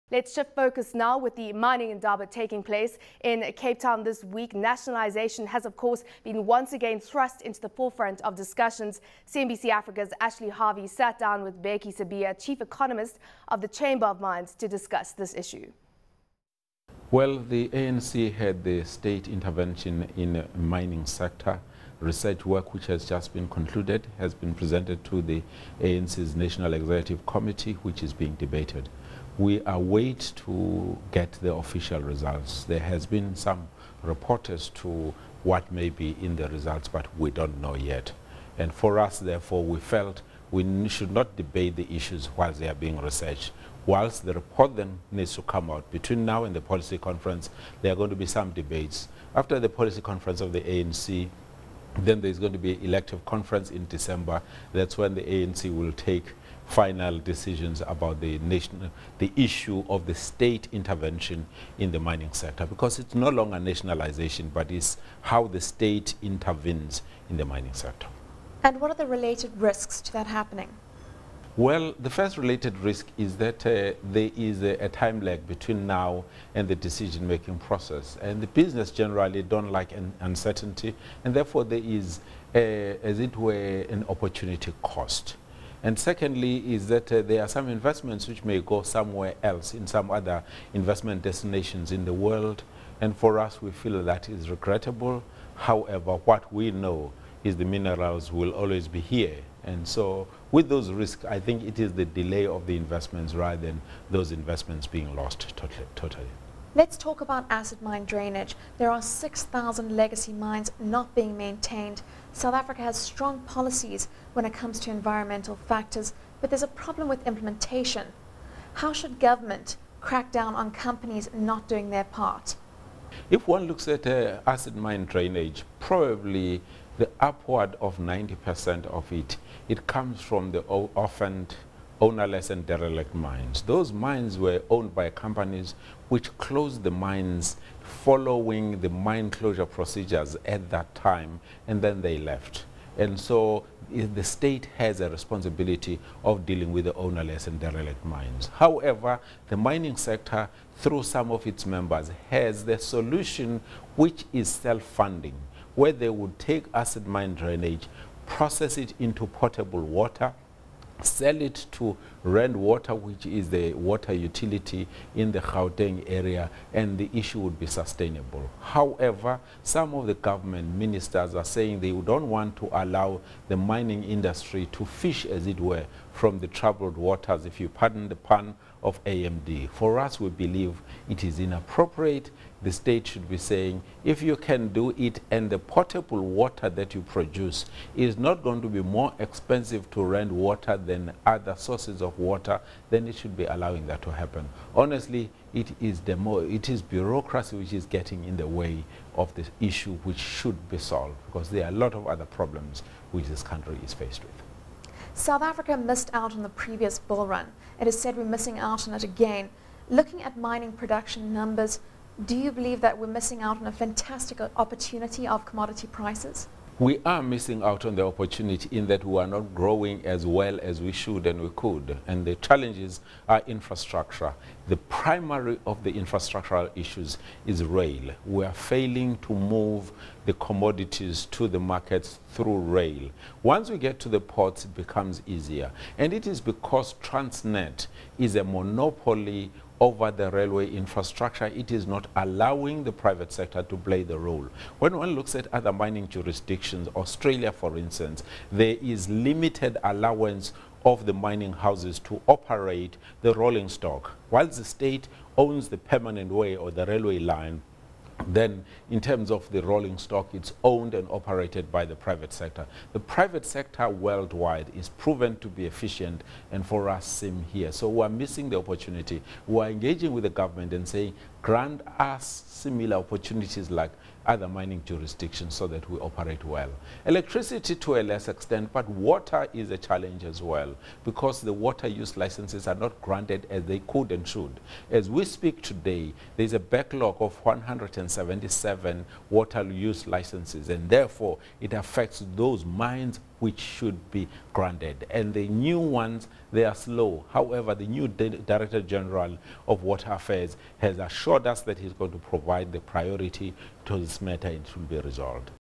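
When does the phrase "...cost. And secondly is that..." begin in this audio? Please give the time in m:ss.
1:24.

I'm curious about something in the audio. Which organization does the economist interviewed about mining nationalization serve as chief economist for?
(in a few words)
Chamber of Mines.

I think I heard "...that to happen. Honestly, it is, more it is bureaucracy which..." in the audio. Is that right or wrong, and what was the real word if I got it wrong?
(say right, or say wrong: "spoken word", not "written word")
right.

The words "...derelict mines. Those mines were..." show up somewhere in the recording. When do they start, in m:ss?
2:12.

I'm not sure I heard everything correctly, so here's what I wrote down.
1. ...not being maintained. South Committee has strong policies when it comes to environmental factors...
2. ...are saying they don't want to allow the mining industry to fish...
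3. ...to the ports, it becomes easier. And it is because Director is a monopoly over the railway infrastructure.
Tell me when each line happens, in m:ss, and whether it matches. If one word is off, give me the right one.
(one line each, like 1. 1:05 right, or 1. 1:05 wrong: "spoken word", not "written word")
1. 1:50 wrong: "Africa", not "Committee"
2. 2:51 right
3. 3:53 wrong: "Transnet", not "Director".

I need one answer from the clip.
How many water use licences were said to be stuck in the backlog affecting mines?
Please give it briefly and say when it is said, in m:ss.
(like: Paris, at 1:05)
177, at 4:47.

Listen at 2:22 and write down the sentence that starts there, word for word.
And so the state has a responsibility of dealing with the ownerless and derelict mines.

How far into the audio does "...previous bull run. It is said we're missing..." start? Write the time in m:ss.
3:26.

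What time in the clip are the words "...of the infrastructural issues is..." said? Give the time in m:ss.
3:45.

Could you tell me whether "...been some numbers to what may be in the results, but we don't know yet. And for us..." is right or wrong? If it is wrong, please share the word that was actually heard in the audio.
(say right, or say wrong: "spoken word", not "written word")
wrong: "reporters", not "numbers".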